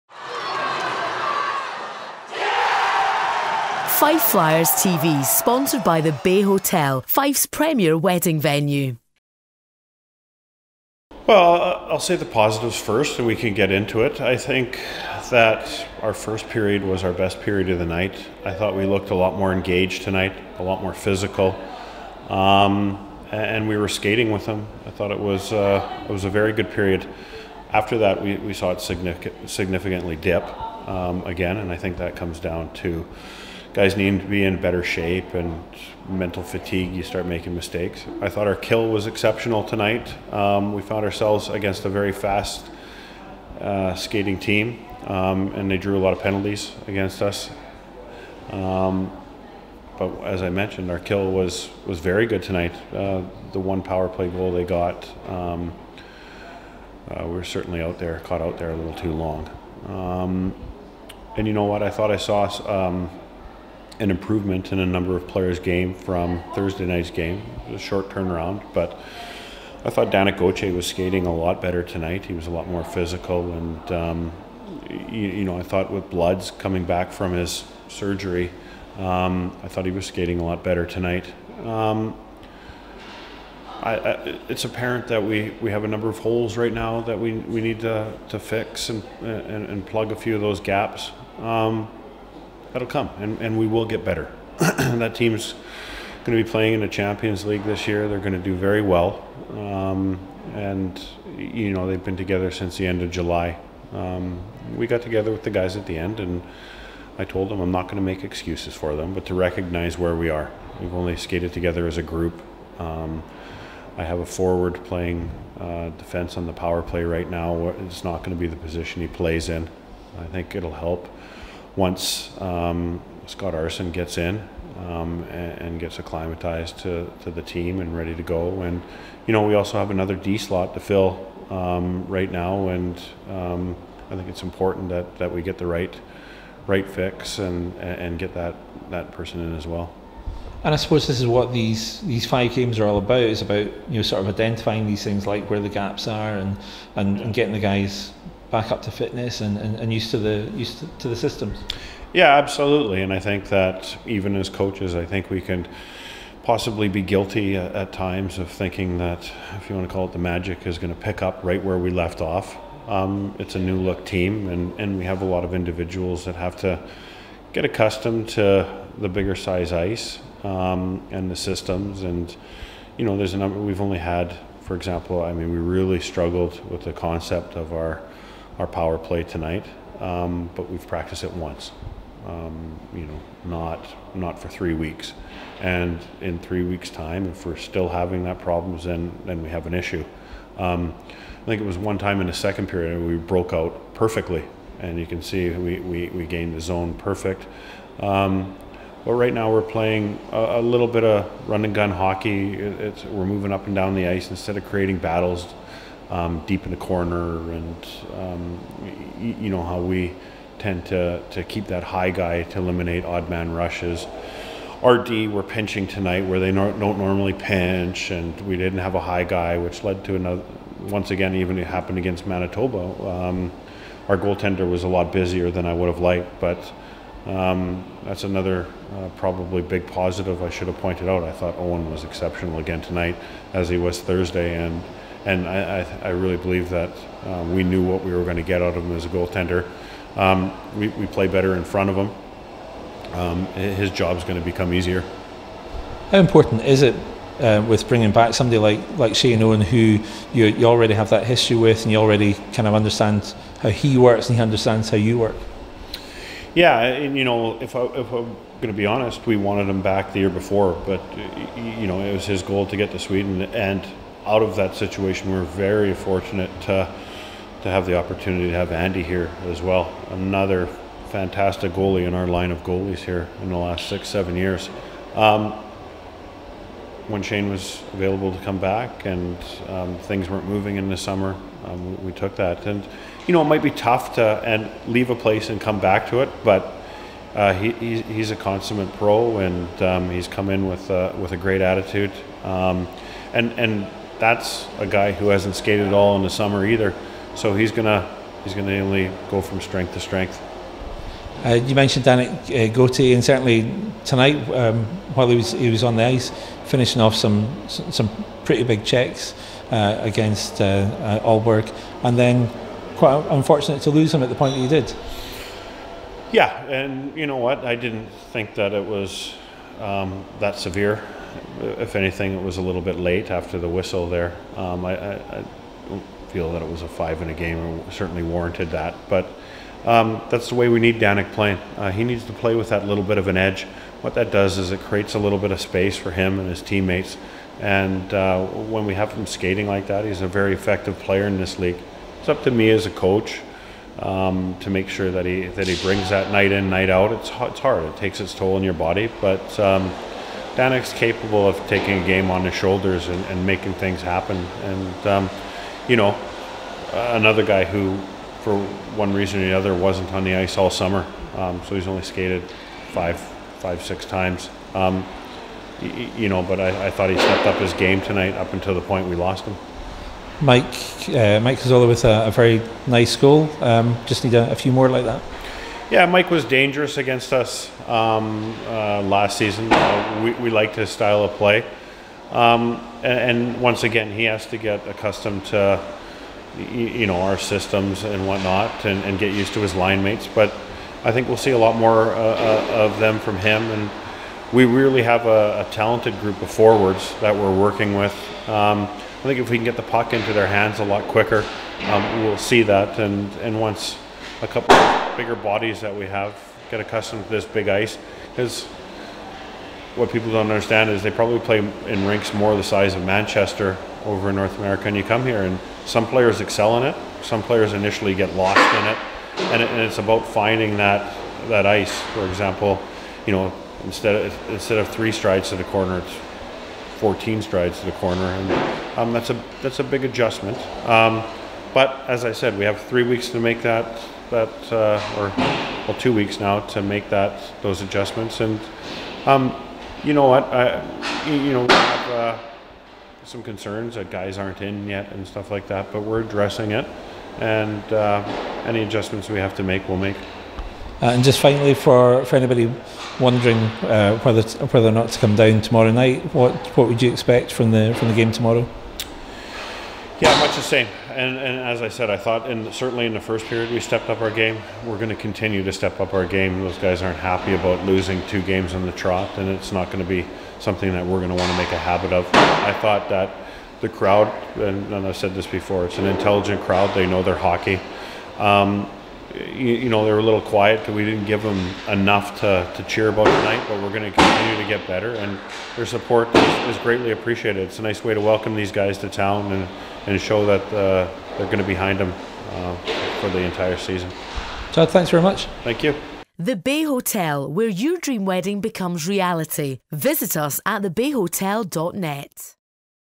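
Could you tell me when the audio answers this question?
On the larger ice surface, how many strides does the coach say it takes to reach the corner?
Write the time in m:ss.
7:06.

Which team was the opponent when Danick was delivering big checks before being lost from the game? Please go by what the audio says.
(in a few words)
Aalborg.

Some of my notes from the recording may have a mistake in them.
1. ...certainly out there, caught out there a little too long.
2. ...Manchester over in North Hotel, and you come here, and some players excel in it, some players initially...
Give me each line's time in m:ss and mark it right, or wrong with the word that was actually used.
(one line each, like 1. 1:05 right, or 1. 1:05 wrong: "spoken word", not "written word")
1. 0:57 right
2. 6:53 wrong: "America", not "Hotel".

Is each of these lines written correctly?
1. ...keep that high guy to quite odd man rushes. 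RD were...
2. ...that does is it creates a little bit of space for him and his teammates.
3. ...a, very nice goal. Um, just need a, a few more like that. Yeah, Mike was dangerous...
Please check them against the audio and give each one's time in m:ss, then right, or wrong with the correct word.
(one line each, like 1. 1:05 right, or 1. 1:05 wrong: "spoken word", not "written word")
1. 3:31 wrong: "eliminate", not "quite"
2. 5:34 right
3. 6:12 right.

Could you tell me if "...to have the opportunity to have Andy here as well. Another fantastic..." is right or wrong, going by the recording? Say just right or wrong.
right.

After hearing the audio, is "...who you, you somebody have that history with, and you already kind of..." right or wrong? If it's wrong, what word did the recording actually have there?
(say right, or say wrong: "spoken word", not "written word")
wrong: "already", not "somebody".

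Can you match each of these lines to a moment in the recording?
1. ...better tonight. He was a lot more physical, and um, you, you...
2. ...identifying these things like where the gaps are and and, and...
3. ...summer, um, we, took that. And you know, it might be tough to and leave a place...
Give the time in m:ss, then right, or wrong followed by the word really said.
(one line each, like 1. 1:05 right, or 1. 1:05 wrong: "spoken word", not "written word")
1. 1:11 right
2. 2:24 right
3. 4:40 right.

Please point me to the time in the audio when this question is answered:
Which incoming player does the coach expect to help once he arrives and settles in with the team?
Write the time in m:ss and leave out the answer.
2:03.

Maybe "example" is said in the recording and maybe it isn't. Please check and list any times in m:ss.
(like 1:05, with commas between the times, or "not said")
2:54, 7:02.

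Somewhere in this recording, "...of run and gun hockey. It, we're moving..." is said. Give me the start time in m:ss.
3:21.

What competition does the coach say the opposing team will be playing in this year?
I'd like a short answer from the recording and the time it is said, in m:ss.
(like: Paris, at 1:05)
Champions League, at 1:36.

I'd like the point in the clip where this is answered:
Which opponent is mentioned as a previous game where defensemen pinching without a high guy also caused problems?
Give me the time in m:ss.
3:42.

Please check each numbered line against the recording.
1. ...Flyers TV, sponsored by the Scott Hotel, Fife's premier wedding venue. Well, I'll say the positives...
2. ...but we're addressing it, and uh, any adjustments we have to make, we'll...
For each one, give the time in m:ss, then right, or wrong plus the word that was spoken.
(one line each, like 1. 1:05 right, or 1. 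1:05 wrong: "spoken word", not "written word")
1. 0:04 wrong: "Bay", not "Scott"
2. 7:25 right.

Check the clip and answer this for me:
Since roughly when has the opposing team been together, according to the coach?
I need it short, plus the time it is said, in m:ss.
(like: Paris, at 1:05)
End of July, at 1:42.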